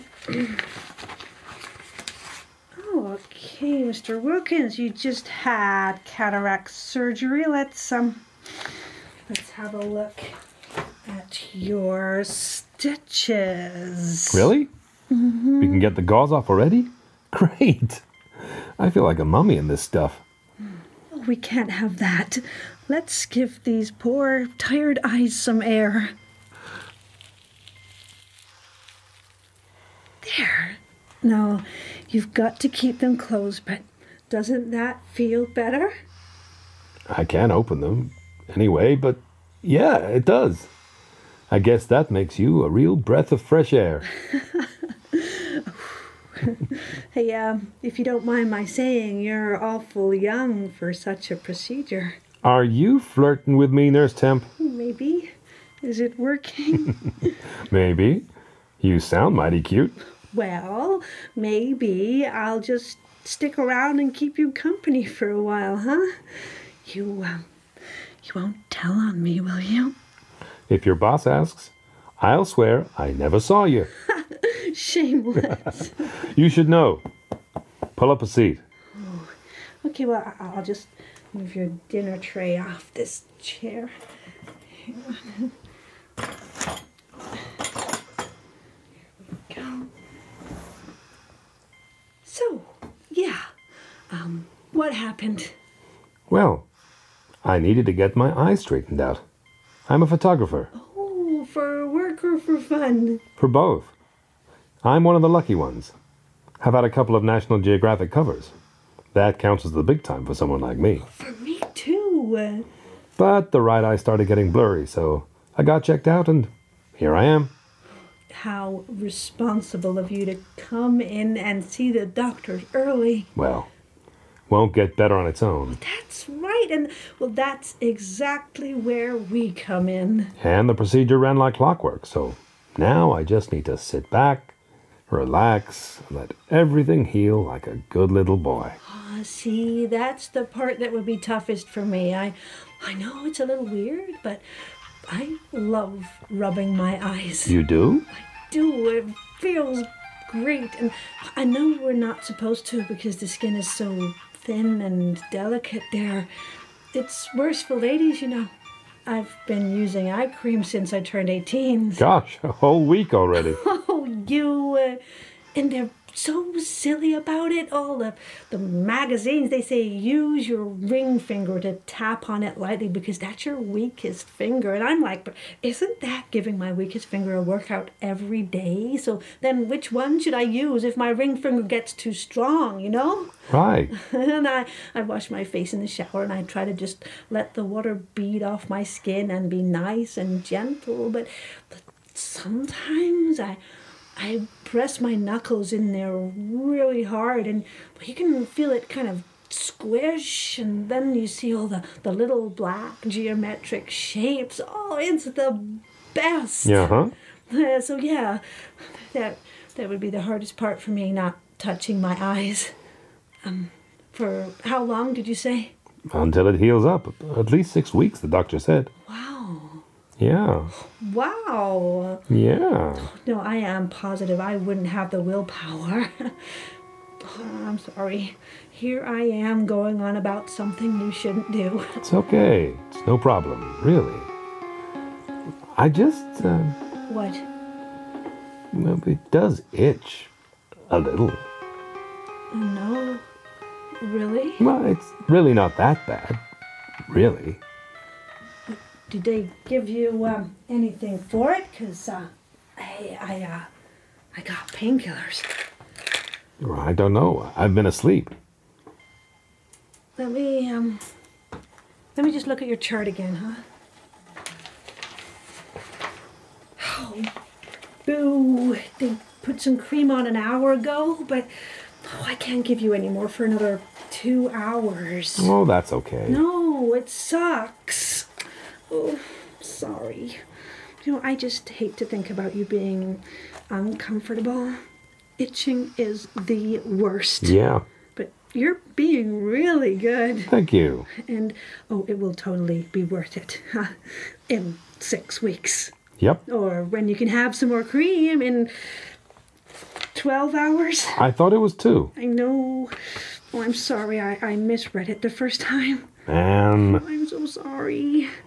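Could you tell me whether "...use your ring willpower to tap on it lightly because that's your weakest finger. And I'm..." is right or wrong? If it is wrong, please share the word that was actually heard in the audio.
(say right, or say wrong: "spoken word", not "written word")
wrong: "finger", not "willpower".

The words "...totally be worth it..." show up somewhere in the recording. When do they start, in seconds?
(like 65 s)
292 s.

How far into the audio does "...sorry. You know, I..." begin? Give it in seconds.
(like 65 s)
279 s.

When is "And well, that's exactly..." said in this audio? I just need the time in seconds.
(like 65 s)
126 s.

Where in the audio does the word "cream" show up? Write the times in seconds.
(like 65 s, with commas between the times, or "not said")
160 s, 269 s, 297 s.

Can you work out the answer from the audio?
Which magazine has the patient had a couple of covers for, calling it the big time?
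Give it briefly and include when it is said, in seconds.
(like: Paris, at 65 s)
National Geographic, at 107 s.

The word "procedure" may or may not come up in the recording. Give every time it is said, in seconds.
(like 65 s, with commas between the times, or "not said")
51 s, 130 s.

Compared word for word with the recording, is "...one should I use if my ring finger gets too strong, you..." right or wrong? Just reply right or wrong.
right.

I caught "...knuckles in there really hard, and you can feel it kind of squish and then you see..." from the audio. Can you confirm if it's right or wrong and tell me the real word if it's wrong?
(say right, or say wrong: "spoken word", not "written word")
right.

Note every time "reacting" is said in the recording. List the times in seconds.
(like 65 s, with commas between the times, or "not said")
not said.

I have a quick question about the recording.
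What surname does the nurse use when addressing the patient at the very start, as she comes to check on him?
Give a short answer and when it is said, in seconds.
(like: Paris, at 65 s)
Wilkins, at 4 s.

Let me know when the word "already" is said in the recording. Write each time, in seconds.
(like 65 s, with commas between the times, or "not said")
16 s, 163 s.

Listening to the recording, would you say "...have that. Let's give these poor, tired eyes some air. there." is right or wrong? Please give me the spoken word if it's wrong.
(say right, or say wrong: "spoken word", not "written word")
right.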